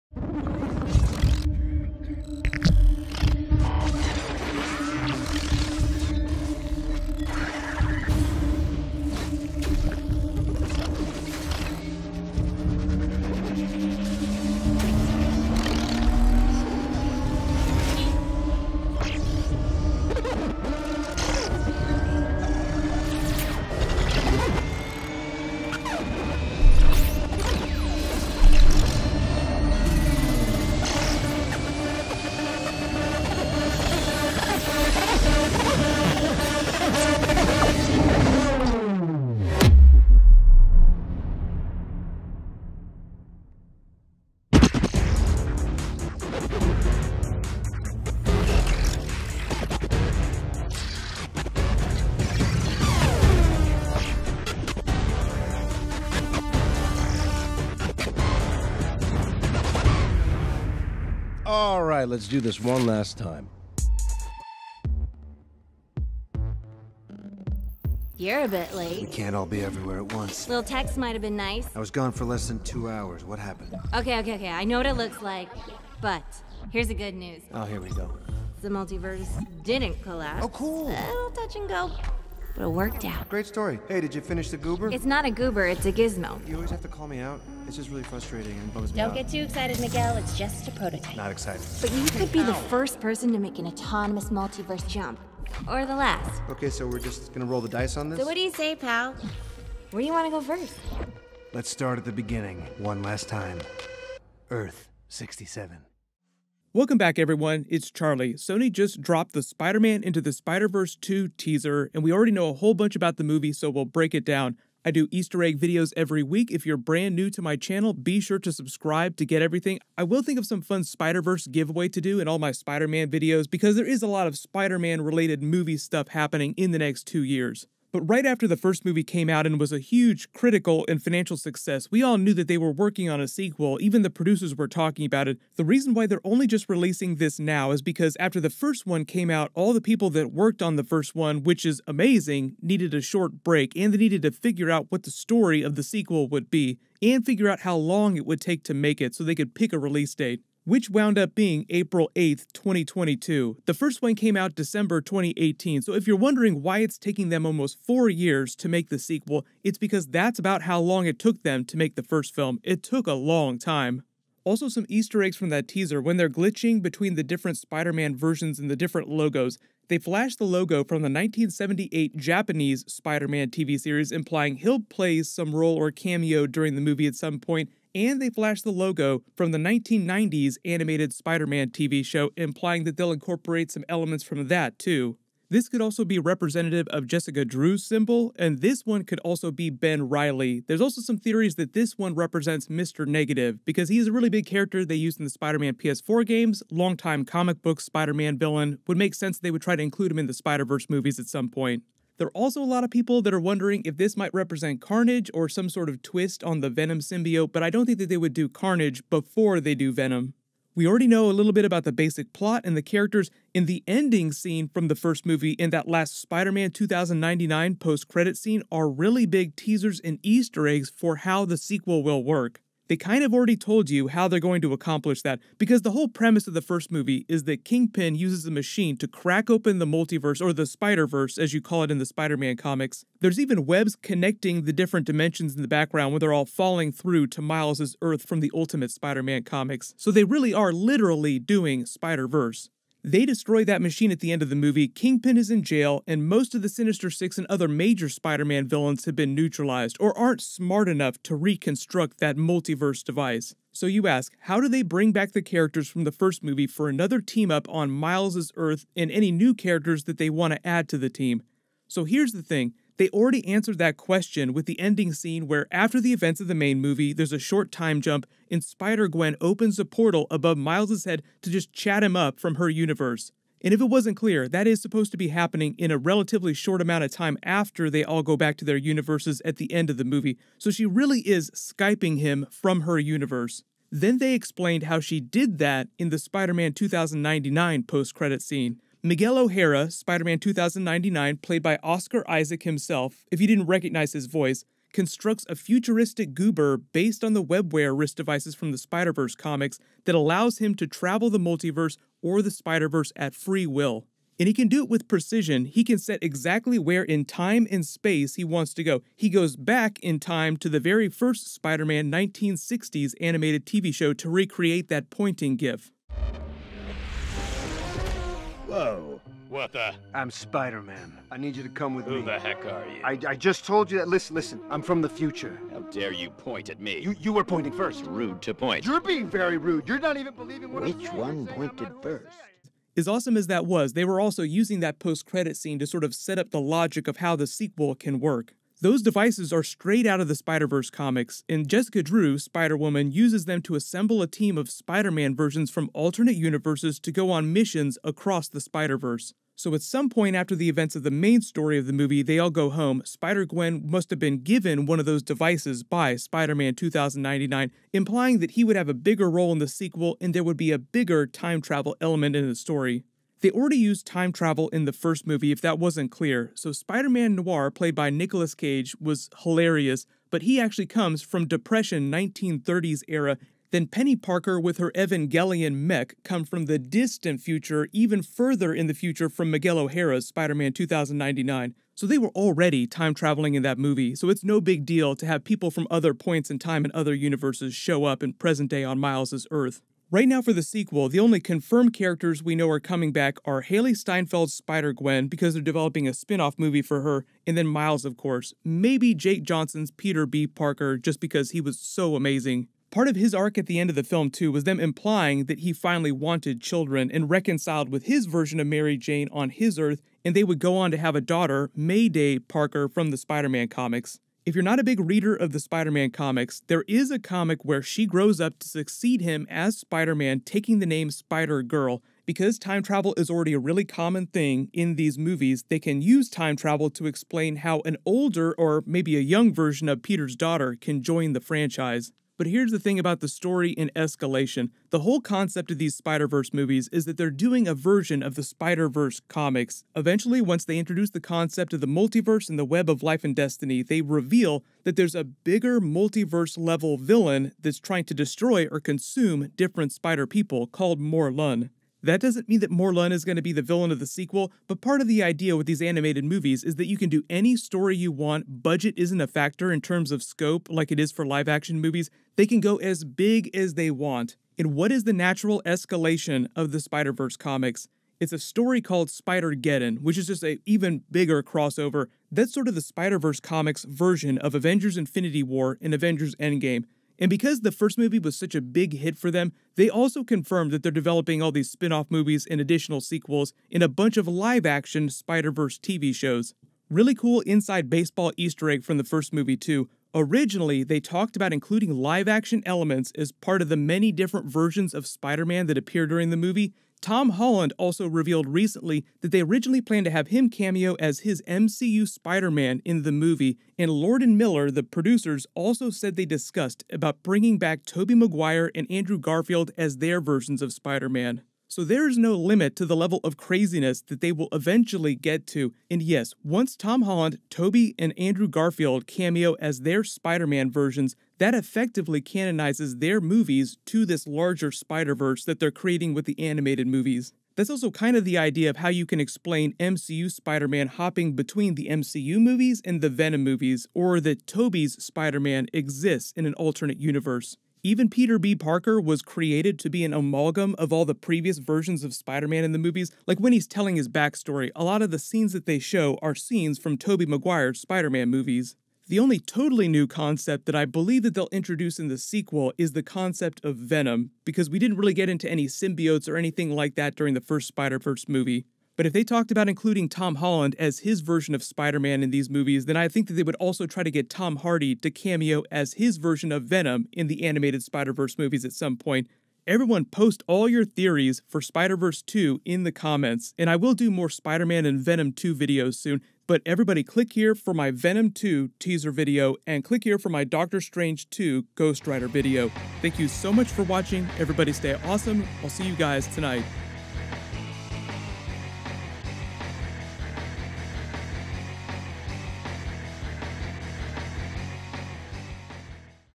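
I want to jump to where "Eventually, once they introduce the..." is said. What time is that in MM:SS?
07:19.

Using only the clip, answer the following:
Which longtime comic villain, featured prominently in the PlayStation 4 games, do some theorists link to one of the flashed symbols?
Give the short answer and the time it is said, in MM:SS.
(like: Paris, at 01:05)
Mr. Negative, at 03:12.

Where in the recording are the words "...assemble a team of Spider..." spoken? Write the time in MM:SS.
05:43.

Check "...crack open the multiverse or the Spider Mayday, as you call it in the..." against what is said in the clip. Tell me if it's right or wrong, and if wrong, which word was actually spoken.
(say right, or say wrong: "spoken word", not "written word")
wrong: "Verse", not "Mayday".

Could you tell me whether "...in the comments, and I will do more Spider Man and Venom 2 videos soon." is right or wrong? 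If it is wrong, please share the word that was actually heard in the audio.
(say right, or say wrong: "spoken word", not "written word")
right.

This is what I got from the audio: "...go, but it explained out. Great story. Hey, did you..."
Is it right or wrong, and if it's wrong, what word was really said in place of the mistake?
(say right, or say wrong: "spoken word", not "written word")
wrong: "worked", not "explained".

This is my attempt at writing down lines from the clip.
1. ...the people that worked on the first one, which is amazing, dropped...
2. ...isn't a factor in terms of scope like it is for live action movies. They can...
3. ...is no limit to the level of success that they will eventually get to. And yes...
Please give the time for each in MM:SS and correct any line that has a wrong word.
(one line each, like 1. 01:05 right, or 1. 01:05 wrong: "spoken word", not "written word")
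1. 02:19 wrong: "needed", not "dropped"
2. 07:38 right
3. 08:32 wrong: "craziness", not "success".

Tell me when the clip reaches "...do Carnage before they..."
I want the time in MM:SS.
03:28.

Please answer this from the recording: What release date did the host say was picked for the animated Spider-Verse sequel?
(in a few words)
April 8th, 2022.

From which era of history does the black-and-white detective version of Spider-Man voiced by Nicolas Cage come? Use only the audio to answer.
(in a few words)
Depression 1930s.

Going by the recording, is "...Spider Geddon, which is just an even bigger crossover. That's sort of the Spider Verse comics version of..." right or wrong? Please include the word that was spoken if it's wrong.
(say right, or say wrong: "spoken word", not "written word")
right.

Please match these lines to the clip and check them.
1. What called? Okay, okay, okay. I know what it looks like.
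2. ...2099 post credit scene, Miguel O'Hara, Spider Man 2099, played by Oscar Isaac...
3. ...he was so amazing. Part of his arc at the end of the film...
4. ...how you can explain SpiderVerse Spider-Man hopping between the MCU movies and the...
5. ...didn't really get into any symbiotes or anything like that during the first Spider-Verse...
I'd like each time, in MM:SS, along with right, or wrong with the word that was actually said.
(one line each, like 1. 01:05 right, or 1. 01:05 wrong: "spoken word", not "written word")
1. 01:13 wrong: "happened", not "called"
2. 04:46 right
3. 06:41 right
4. 08:48 wrong: "MCU", not "SpiderVerse"
5. 09:14 right.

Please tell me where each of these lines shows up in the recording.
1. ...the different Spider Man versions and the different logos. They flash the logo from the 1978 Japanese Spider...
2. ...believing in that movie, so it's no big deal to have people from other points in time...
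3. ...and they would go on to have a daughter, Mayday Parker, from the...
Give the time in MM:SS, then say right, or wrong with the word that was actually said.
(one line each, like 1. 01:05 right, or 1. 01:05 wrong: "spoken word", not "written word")
1. 02:47 right
2. 06:23 wrong: "traveling", not "believing"
3. 06:50 right.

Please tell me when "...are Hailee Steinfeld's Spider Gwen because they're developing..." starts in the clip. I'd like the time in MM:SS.
06:33.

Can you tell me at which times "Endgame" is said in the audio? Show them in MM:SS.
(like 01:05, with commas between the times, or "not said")
07:56.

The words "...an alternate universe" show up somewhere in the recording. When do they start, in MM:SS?
08:56.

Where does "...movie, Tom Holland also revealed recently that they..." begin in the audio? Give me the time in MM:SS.
08:16.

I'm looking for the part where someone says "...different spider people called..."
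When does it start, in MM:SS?
07:29.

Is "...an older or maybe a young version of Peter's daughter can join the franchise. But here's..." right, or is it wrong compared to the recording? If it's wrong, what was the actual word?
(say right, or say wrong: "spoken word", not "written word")
right.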